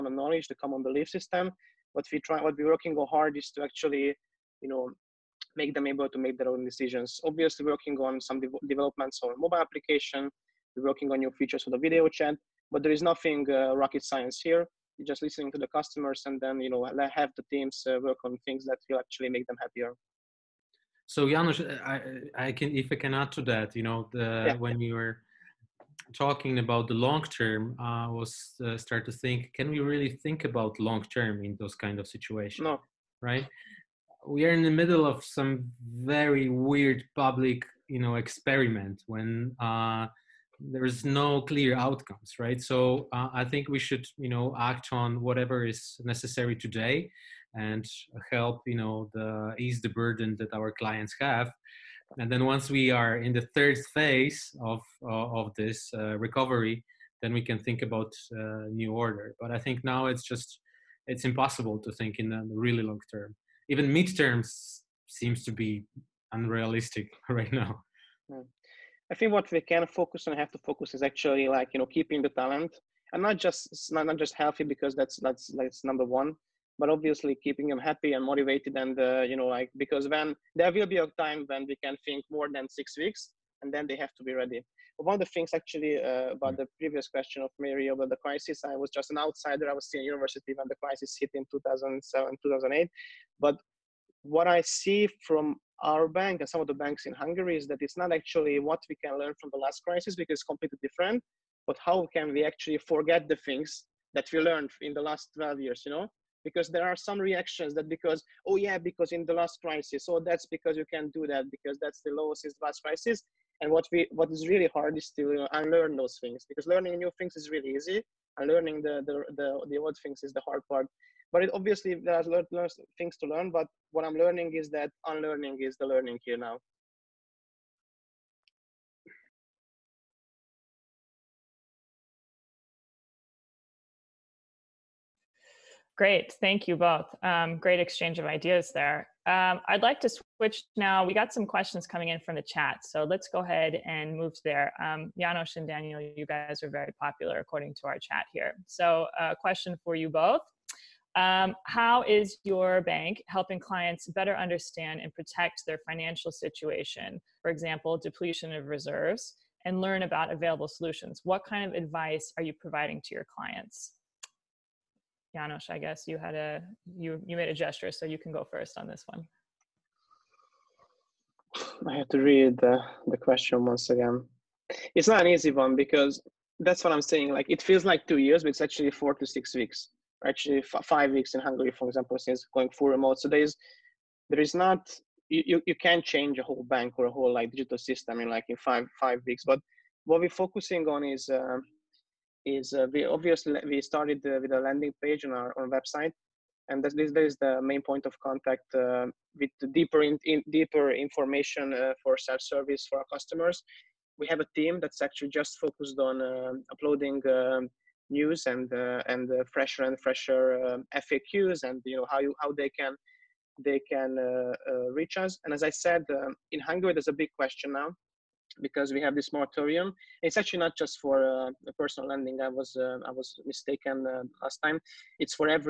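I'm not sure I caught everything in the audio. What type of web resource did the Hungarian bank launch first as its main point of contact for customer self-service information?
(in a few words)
landing page.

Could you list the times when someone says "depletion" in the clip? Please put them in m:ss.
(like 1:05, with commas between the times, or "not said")
2:37.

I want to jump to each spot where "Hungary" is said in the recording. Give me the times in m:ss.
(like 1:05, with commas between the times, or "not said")
1:37, 3:01, 3:36.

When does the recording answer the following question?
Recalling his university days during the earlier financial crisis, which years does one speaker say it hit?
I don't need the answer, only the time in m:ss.
1:31.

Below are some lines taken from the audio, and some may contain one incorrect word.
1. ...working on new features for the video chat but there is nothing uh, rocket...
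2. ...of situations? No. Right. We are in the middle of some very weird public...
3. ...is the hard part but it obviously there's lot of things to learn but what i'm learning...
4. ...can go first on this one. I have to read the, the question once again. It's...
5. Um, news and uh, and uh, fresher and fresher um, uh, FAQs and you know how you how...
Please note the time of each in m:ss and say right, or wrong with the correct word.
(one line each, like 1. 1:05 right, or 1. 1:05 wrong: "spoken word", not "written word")
1. 0:10 right
2. 0:31 right
3. 2:00 right
4. 2:48 right
5. 3:27 right.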